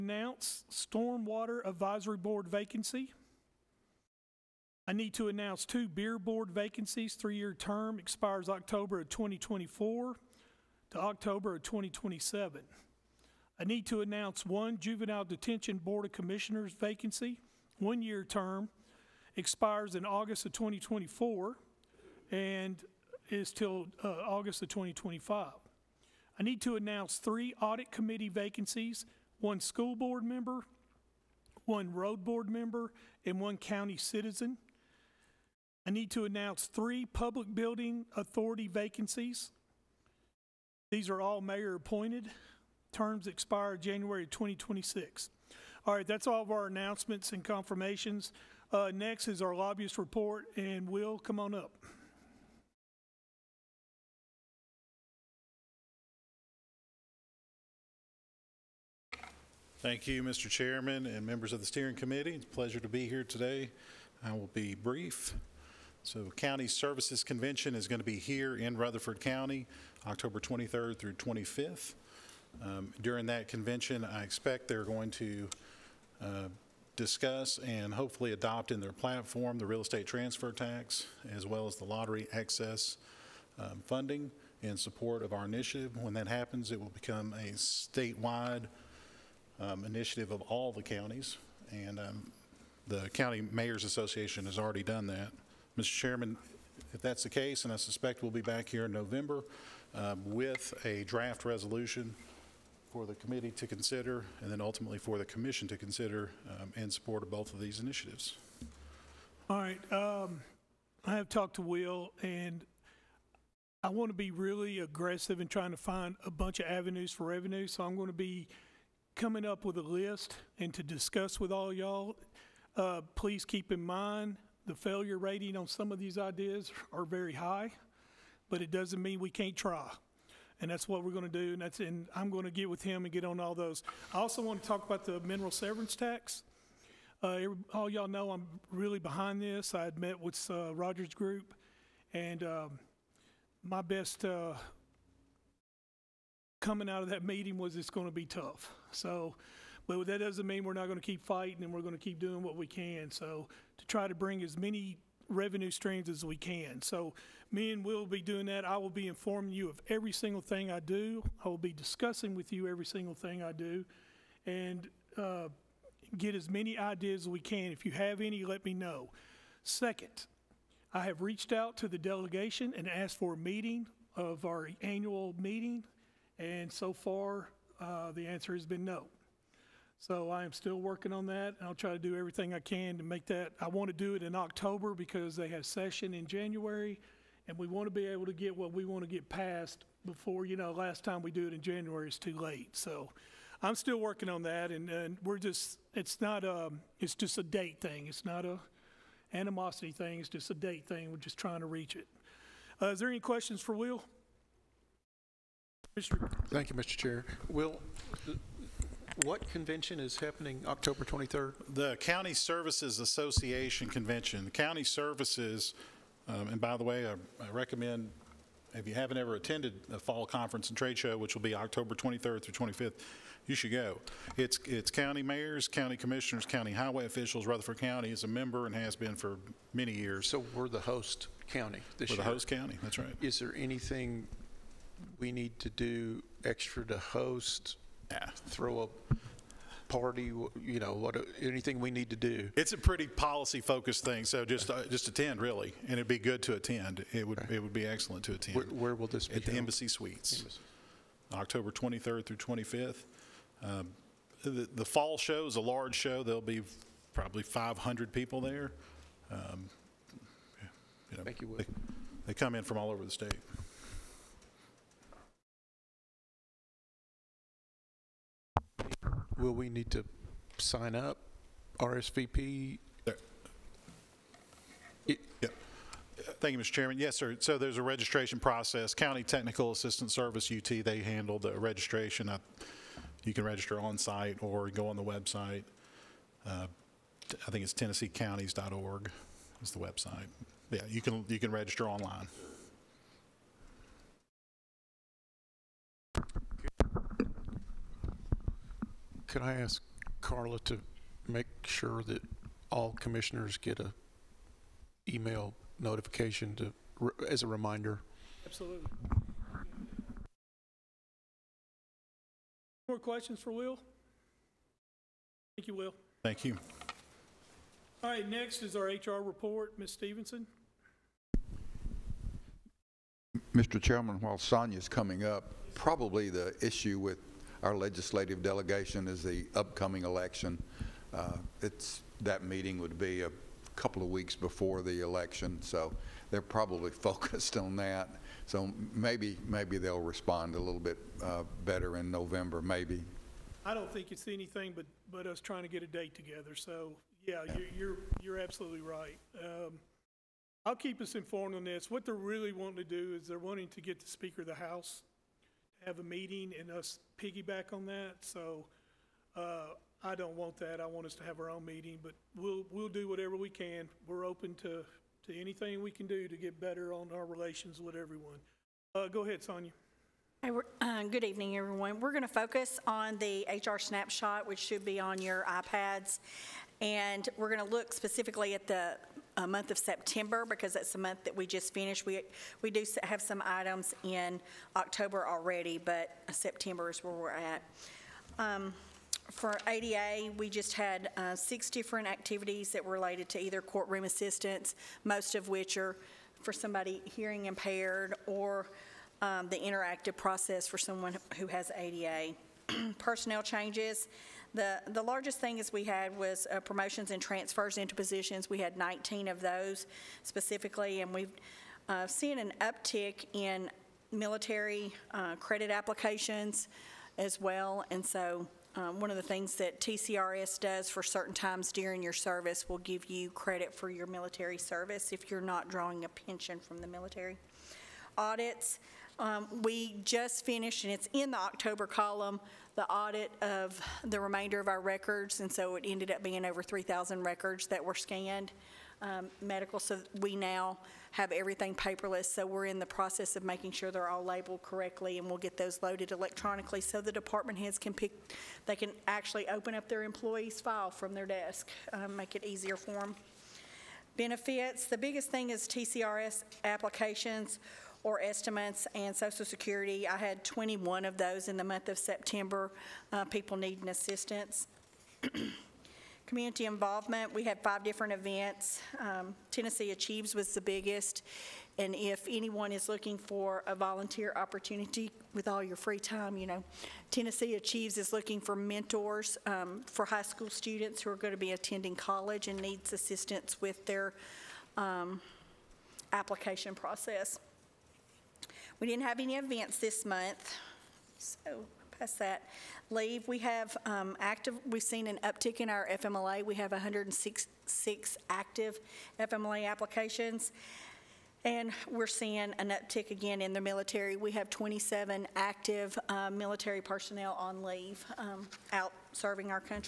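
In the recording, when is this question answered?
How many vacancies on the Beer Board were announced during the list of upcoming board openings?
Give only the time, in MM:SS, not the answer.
00:05.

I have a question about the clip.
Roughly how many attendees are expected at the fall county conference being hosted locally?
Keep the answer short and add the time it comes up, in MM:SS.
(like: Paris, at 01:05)
500, at 04:17.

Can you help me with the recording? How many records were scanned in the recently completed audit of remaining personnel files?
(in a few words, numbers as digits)
over 3,000.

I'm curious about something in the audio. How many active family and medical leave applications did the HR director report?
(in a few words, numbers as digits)
106.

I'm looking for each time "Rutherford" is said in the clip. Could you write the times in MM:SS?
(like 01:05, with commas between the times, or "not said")
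01:08, 03:47.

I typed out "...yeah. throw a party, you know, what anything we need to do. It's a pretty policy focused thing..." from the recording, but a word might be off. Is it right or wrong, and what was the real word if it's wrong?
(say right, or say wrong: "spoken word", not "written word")
right.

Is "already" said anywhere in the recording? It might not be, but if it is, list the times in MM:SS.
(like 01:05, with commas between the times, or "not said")
01:34, 06:25.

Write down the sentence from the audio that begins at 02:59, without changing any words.
So I am still working on that, and I'll try to do everything I can to make that.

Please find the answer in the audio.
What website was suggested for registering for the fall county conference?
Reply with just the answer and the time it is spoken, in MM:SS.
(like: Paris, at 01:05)
tennesseecounties.org, at 04:47.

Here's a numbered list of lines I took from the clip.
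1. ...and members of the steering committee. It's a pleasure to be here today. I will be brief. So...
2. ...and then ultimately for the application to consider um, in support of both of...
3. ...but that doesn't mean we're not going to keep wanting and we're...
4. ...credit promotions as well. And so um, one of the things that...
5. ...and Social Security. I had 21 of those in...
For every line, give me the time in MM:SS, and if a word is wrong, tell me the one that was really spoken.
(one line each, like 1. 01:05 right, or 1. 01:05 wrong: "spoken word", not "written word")
1. 01:01 right
2. 01:44 wrong: "commission", not "application"
3. 02:29 wrong: "fighting", not "wanting"
4. 06:55 wrong: "applications", not "promotions"
5. 07:38 right.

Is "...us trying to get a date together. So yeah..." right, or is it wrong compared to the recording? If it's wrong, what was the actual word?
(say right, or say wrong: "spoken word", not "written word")
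right.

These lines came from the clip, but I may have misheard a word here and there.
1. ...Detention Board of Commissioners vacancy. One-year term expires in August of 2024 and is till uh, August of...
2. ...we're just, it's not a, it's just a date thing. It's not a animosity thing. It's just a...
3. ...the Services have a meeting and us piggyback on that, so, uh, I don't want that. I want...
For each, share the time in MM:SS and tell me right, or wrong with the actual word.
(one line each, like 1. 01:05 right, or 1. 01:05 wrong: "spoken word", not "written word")
1. 00:15 right
2. 03:15 right
3. 05:54 wrong: "House", not "Services".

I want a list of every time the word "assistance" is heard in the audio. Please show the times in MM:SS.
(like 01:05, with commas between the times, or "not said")
04:39, 06:34, 07:43, 08:02.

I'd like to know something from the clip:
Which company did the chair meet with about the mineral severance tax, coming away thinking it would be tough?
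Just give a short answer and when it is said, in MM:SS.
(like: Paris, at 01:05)
Rogers Group, at 02:20.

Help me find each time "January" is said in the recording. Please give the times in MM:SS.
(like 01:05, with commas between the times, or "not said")
00:43, 03:06, 03:11.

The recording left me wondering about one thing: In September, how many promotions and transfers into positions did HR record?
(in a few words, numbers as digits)
19.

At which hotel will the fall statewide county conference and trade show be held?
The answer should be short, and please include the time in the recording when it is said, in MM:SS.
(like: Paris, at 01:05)
Embassy Suites, at 04:09.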